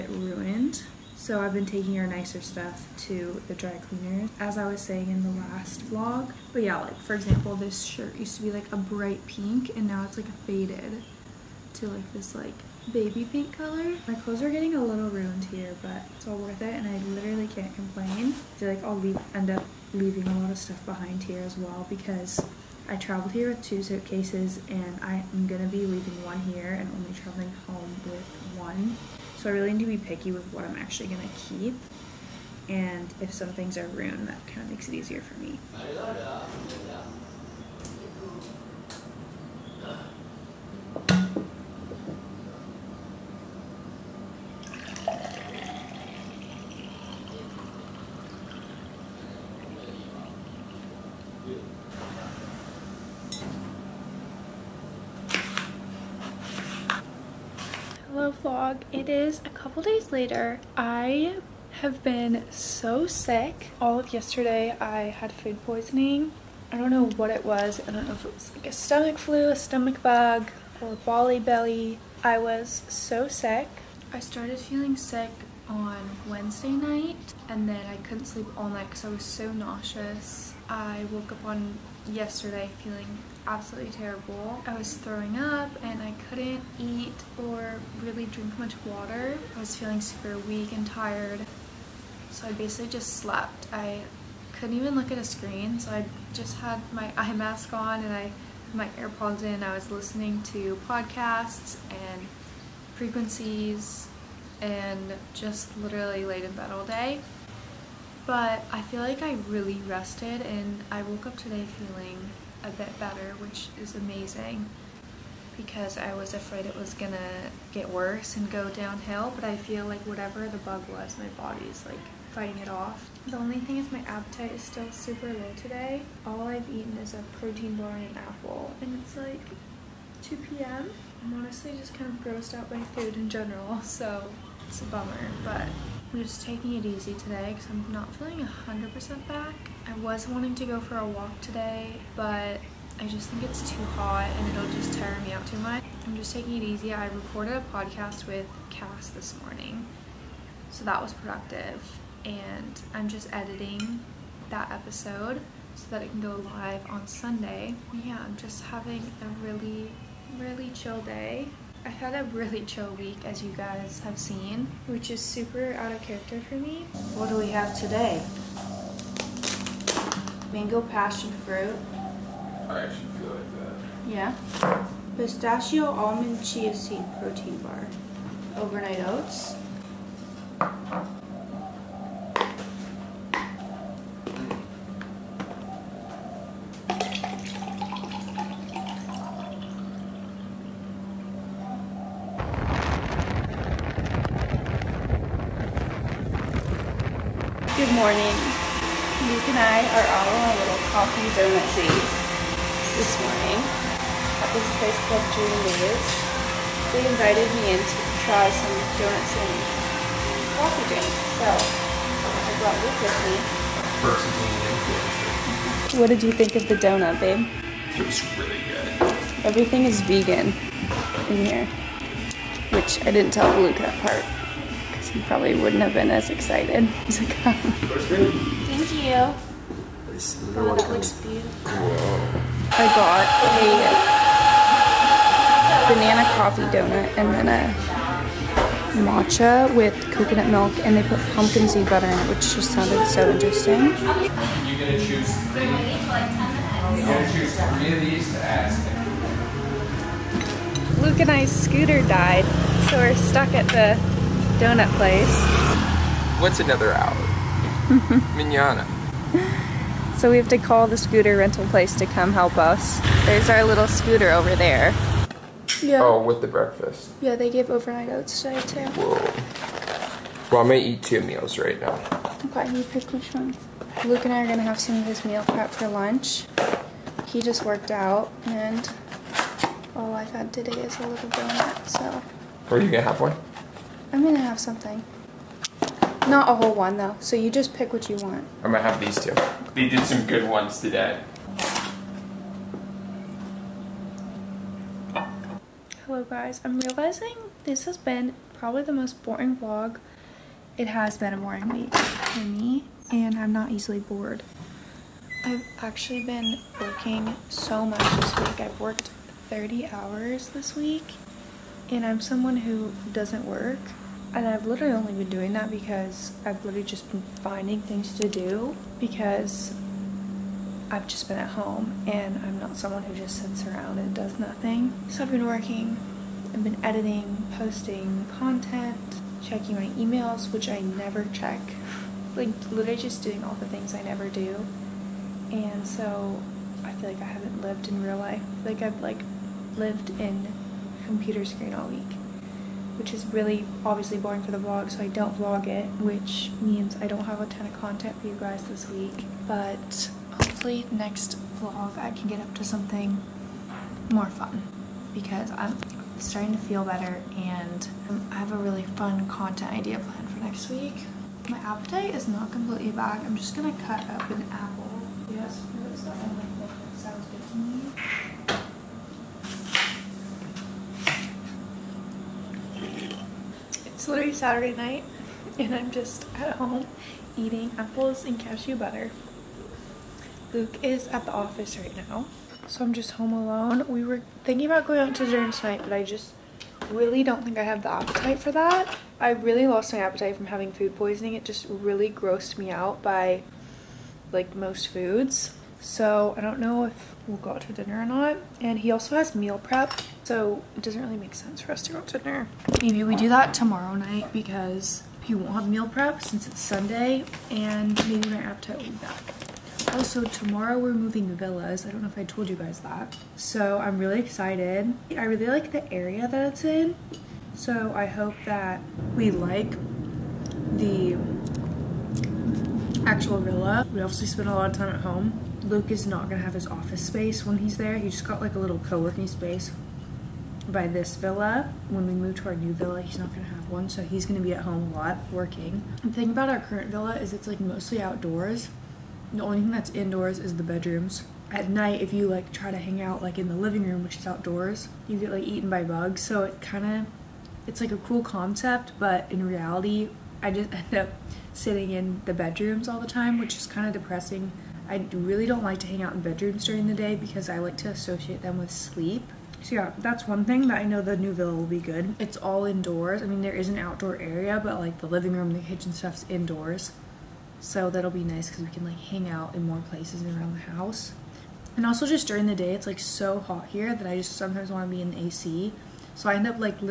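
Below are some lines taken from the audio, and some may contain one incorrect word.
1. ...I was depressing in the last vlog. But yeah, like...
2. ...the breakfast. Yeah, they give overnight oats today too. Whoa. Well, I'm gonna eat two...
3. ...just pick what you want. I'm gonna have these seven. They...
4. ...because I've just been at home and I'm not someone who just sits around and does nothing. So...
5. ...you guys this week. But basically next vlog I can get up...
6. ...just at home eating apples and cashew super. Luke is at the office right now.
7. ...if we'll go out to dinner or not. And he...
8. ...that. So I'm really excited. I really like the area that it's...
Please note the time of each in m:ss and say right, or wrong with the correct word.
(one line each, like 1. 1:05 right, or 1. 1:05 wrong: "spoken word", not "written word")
1. 0:04 wrong: "saying", not "depressing"
2. 4:26 right
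3. 4:47 wrong: "two", not "seven"
4. 5:18 right
5. 5:48 wrong: "hopefully", not "basically"
6. 6:15 wrong: "butter", not "super"
7. 6:36 right
8. 6:52 right.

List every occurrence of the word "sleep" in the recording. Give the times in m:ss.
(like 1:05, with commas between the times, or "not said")
1:18, 7:38.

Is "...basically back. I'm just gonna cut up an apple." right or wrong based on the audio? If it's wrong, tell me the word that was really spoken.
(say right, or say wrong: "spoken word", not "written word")
wrong: "completely", not "basically".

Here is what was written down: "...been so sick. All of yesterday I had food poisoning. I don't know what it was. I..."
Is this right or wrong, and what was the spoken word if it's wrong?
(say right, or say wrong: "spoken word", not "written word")
right.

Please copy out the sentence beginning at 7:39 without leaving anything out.
So yeah, that's one thing that I know the new villa will be good.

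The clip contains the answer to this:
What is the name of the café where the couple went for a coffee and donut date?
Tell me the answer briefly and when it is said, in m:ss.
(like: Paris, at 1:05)
Julia's, at 3:25.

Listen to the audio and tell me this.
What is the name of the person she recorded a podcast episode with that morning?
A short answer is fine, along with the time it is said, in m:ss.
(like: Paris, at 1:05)
Cass, at 2:28.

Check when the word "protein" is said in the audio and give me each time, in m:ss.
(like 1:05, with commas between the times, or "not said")
2:07, 2:57.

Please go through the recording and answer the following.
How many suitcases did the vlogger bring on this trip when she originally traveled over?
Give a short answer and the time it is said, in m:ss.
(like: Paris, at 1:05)
2, at 0:23.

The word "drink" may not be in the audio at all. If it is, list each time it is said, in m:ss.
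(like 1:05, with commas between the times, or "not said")
1:28, 3:30.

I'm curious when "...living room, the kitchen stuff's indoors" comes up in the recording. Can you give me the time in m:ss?
7:45.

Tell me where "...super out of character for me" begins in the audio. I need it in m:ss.
2:45.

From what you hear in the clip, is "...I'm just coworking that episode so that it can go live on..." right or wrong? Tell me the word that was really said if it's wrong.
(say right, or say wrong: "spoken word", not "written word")
wrong: "editing", not "coworking".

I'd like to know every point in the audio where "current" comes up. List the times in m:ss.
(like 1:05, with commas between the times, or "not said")
7:16.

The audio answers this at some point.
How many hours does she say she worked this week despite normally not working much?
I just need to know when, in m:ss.
5:09.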